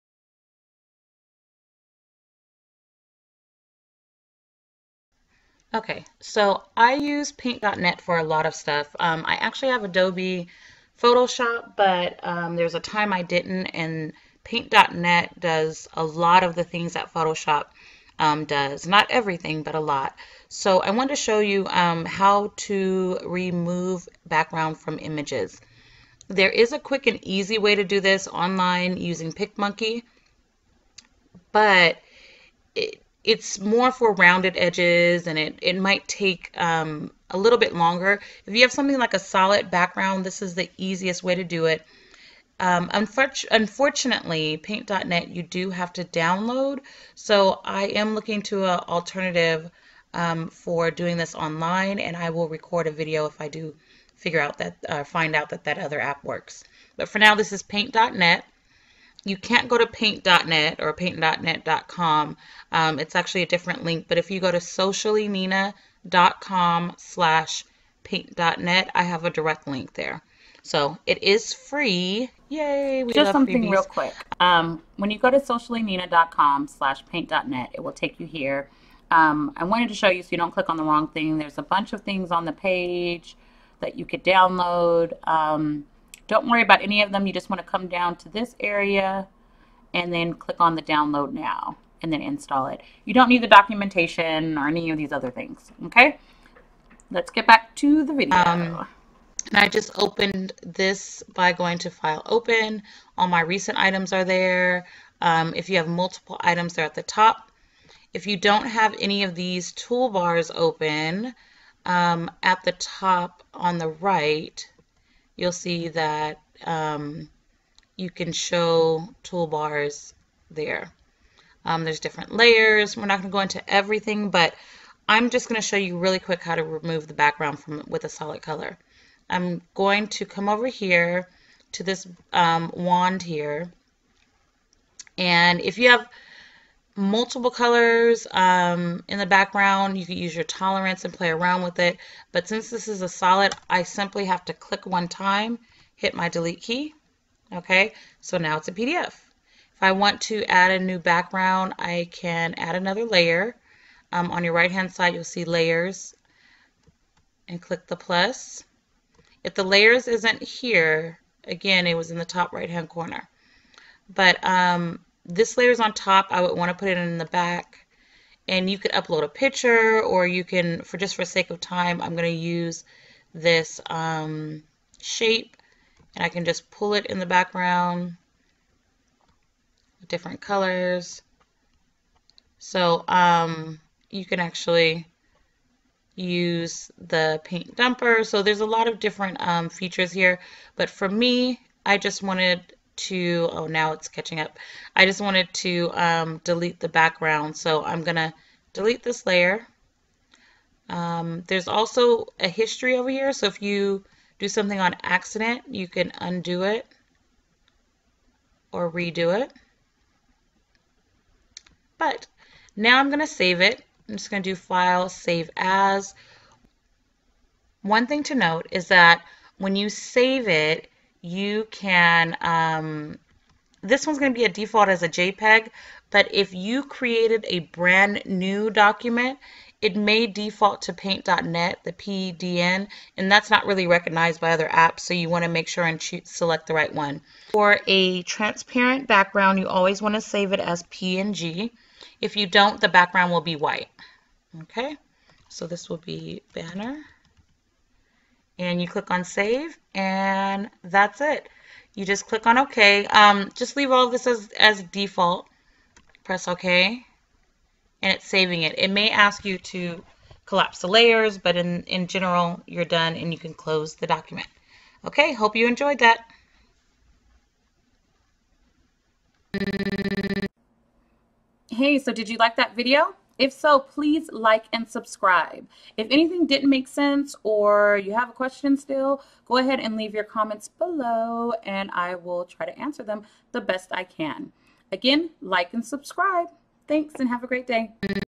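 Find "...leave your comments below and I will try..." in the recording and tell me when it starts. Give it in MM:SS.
04:39.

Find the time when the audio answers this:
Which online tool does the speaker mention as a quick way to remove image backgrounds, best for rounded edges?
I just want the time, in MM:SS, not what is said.
00:29.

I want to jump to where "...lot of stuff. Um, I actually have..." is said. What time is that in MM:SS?
00:08.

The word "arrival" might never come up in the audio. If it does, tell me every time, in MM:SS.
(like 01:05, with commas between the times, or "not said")
not said.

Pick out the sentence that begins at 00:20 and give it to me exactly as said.
So I wanted to show you um, how to remove background from images.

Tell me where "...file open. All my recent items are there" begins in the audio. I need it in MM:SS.
01:41.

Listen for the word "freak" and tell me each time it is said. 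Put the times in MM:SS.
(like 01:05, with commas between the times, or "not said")
not said.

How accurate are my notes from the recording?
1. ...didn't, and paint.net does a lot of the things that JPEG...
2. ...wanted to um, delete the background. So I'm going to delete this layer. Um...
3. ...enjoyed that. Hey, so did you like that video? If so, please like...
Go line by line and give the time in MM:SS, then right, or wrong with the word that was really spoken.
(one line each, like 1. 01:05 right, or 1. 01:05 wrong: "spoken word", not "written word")
1. 00:13 wrong: "Photoshop", not "JPEG"
2. 03:15 right
3. 04:25 right.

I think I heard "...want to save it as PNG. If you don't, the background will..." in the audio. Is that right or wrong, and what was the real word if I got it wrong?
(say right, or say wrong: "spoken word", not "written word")
right.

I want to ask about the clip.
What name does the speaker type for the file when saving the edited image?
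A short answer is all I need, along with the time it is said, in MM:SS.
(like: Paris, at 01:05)
banner, at 04:06.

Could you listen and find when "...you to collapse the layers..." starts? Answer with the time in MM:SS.
04:19.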